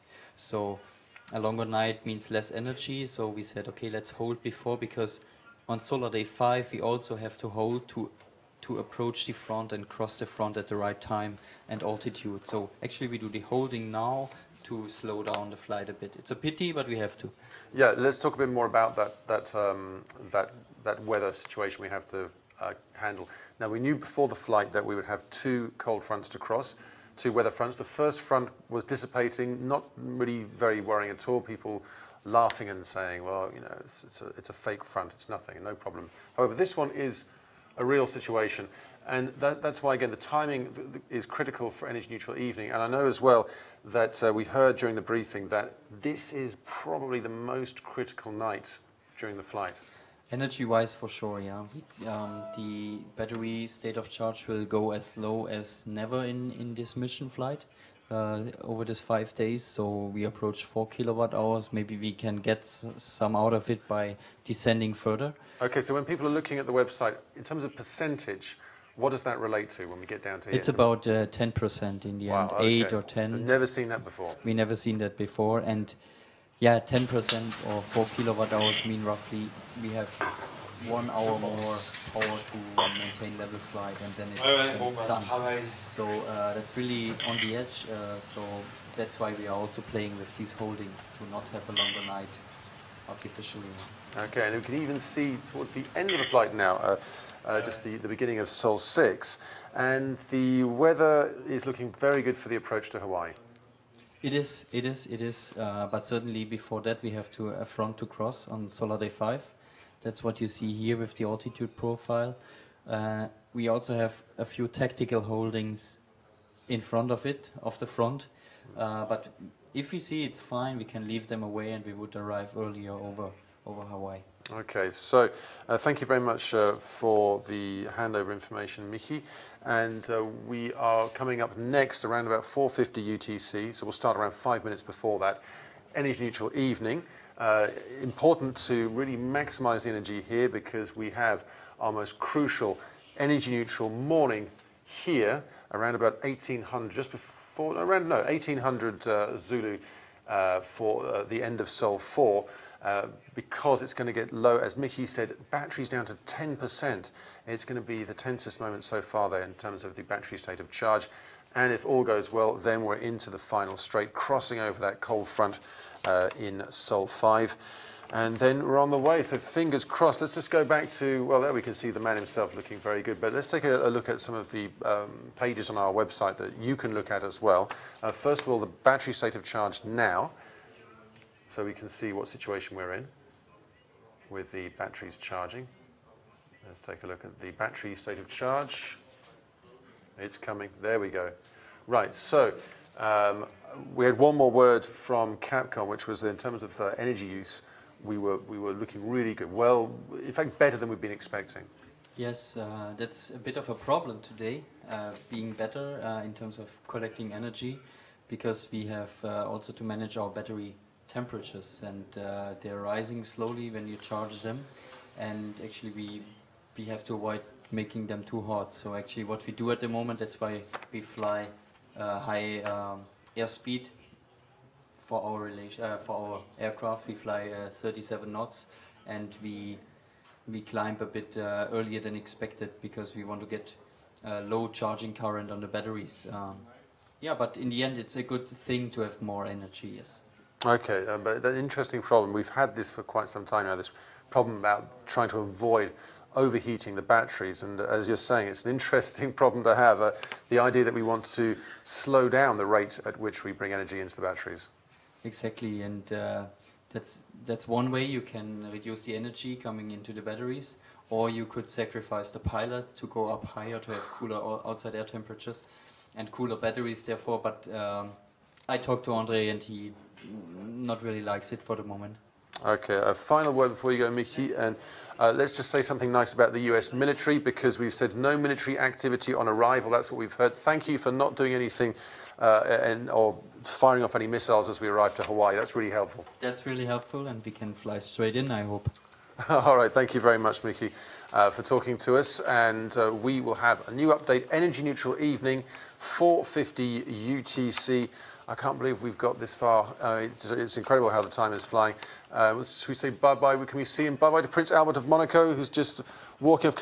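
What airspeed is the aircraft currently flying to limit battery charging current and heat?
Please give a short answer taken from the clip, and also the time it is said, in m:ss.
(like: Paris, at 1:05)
37 knots, at 3:47.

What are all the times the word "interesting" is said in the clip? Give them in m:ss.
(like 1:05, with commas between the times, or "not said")
4:01, 4:08.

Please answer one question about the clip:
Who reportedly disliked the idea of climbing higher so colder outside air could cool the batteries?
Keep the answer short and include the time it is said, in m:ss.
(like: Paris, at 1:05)
Andre, at 4:29.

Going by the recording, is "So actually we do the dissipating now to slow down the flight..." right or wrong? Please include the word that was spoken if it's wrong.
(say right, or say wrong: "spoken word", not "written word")
wrong: "holding", not "dissipating".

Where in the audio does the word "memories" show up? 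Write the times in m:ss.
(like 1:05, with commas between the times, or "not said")
not said.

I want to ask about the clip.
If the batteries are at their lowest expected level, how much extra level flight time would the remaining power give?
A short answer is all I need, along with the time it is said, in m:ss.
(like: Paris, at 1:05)
1 hour, at 1:20.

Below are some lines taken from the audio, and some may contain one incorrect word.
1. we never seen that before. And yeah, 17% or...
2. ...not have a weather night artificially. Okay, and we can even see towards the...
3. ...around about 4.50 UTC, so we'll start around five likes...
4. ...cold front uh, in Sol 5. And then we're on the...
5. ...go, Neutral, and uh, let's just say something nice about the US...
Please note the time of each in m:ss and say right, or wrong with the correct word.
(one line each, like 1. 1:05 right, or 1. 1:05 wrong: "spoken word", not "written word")
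1. 1:14 wrong: "10", not "17"
2. 1:31 wrong: "longer", not "weather"
3. 2:12 wrong: "minutes", not "likes"
4. 2:45 right
5. 4:33 wrong: "Mickey", not "Neutral".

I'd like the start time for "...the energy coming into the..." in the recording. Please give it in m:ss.
4:19.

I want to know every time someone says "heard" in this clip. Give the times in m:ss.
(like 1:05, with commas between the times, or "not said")
0:44, 4:40.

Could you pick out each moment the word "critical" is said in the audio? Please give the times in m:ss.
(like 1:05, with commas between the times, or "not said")
0:41, 0:47.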